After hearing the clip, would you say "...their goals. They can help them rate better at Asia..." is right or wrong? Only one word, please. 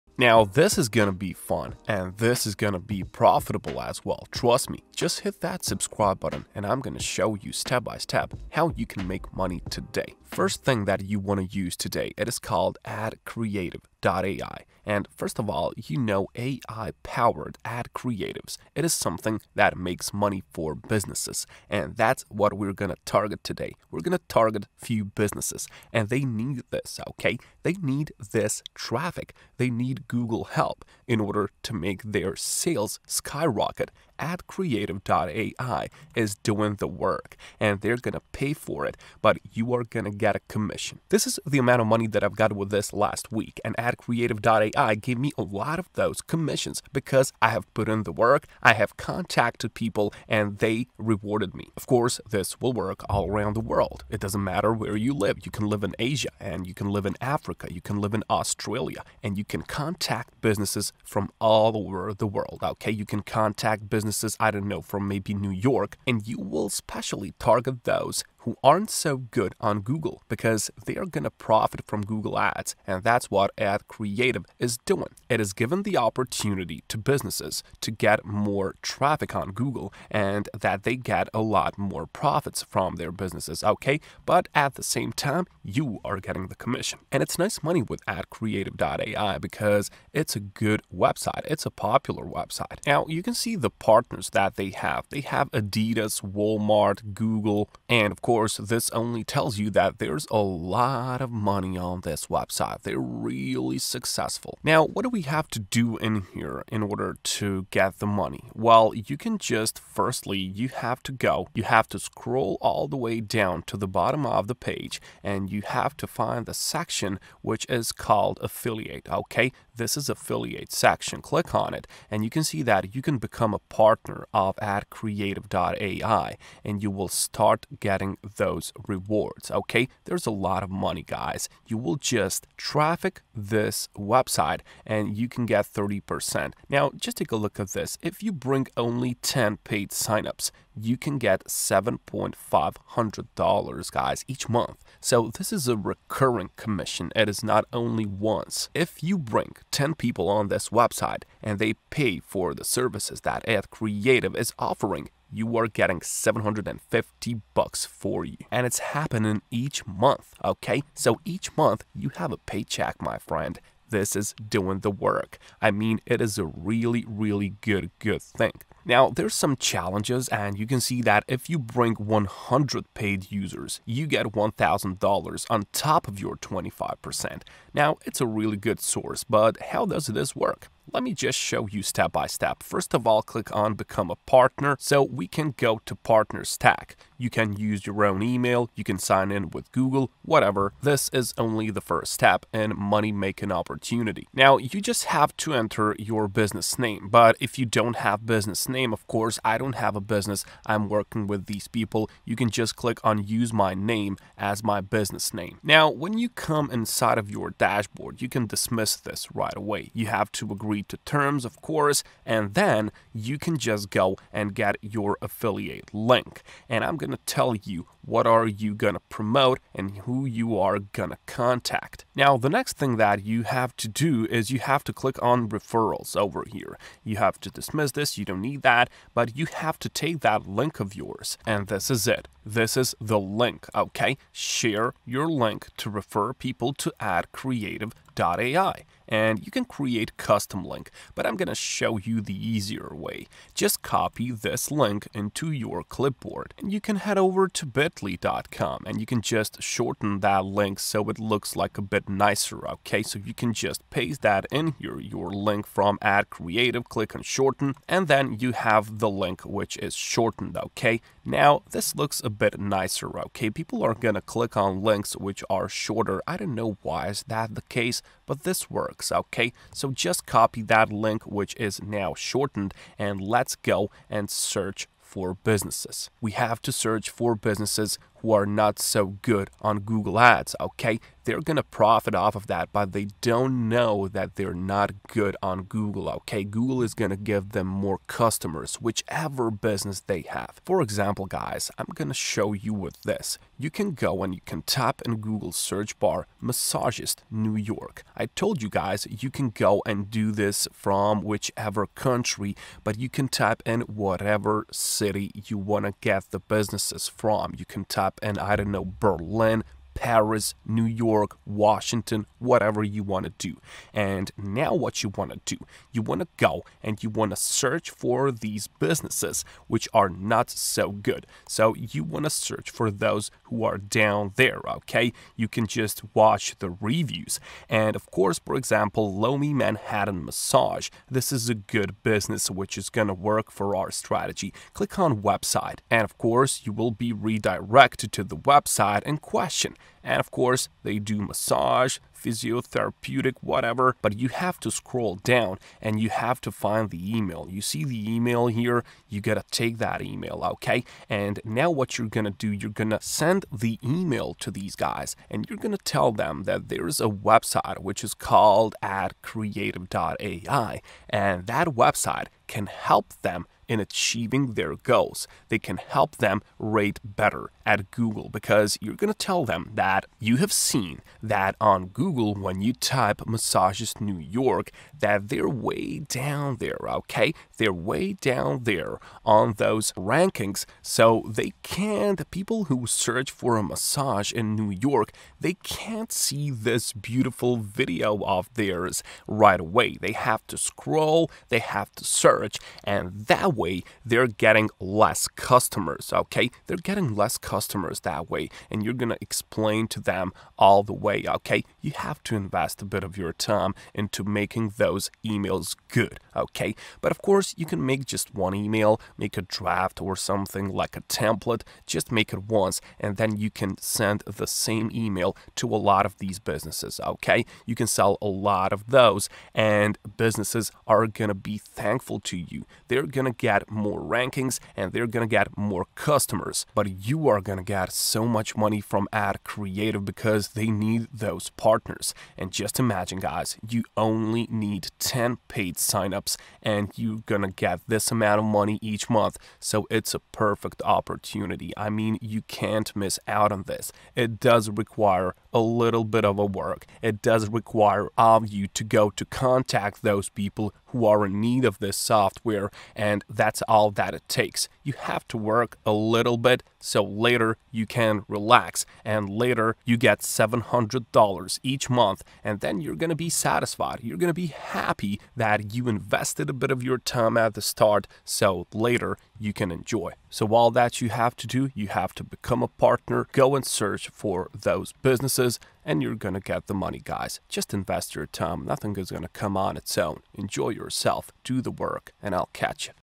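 wrong.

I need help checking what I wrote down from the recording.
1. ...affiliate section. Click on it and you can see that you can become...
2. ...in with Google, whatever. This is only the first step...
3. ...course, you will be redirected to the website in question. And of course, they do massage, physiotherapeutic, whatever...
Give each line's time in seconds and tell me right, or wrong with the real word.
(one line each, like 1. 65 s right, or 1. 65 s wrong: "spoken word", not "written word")
1. 120 s right
2. 189 s right
3. 336 s right.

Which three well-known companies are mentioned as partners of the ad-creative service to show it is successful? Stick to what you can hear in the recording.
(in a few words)
Adidas, Walmart, Google.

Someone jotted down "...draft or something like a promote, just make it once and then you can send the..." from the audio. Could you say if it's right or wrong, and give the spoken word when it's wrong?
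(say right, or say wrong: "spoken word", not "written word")
wrong: "template", not "promote".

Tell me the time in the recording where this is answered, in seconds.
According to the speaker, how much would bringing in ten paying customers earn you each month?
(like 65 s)
141 s.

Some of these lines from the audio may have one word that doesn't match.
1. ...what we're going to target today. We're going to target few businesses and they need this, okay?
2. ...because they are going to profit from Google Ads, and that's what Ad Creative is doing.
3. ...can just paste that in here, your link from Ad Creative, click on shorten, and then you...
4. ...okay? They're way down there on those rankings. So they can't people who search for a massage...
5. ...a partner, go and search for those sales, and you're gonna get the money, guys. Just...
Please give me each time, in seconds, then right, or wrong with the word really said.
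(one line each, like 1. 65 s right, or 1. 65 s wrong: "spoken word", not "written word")
1. 22 s right
2. 70 s right
3. 253 s right
4. 376 s right
5. 472 s wrong: "businesses", not "sales".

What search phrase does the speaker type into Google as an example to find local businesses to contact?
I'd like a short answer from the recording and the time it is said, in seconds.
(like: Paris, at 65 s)
massagist New York, at 296 s.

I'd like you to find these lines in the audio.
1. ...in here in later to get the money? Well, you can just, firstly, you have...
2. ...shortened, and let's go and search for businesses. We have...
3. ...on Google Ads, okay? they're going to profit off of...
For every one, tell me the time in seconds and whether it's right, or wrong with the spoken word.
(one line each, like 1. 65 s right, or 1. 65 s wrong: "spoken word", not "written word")
1. 105 s wrong: "order", not "later"
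2. 272 s right
3. 279 s right.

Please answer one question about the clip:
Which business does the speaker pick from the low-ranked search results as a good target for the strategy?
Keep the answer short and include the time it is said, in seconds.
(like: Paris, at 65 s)
Lomi Manhattan Massage, at 329 s.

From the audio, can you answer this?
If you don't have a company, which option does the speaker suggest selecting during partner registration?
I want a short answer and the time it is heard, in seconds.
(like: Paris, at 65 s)
Use My Name, at 203 s.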